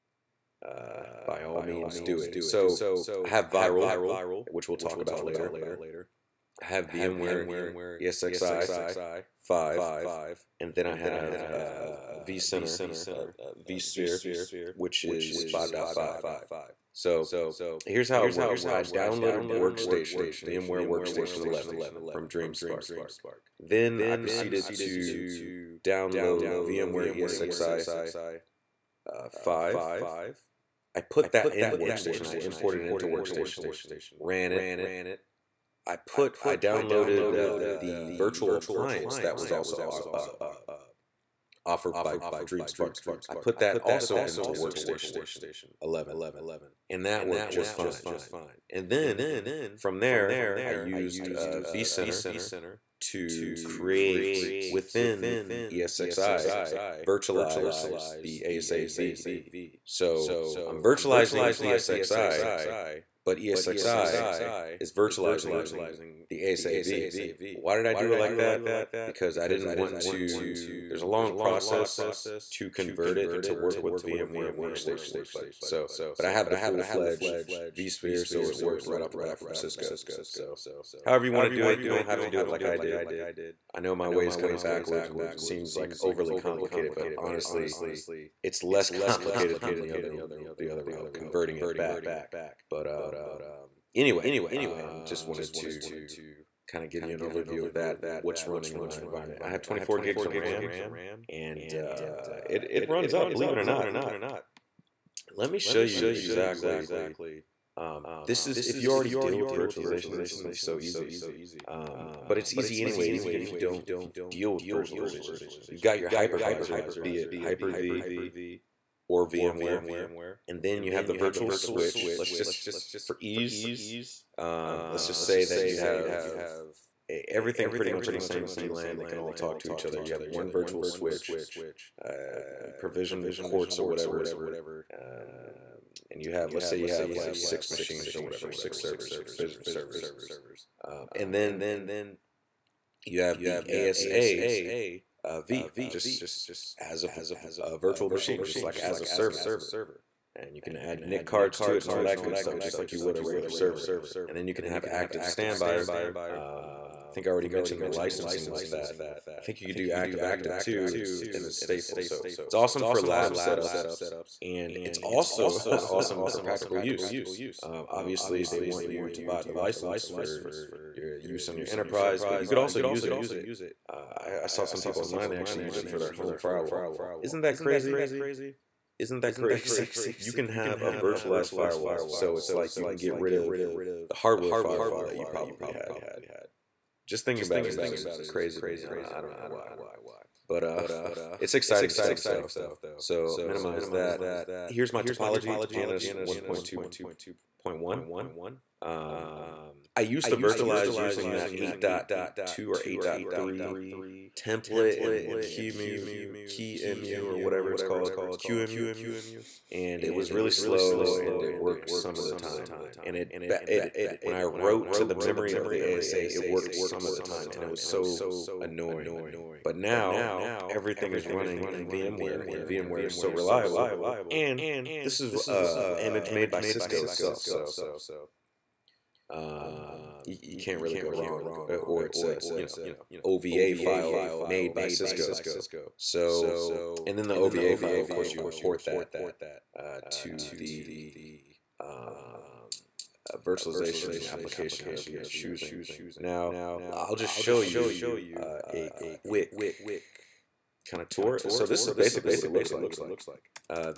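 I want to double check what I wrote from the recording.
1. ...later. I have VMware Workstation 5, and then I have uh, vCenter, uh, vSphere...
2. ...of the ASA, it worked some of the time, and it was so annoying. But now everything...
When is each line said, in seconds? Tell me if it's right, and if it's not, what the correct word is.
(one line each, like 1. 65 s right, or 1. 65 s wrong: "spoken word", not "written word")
1. 5 s wrong: "ESXi", not "Workstation"
2. 215 s right.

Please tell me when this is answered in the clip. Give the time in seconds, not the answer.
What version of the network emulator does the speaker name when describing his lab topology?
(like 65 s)
196 s.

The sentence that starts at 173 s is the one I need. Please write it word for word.
Uh, I, I, saw some people online they actually use it for their home firewall.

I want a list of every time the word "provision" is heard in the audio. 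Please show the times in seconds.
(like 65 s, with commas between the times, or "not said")
132 s, 139 s.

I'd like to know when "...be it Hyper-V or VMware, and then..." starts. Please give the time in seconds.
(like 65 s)
117 s.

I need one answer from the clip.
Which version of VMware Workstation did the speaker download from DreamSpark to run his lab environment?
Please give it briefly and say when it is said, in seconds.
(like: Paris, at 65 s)
11, at 20 s.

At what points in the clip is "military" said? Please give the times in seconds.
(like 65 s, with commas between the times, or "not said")
not said.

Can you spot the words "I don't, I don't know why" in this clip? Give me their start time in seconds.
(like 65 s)
188 s.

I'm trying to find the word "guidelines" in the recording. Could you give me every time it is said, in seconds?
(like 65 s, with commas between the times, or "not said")
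not said.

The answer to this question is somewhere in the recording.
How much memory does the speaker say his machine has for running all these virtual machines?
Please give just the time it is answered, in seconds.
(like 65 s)
99 s.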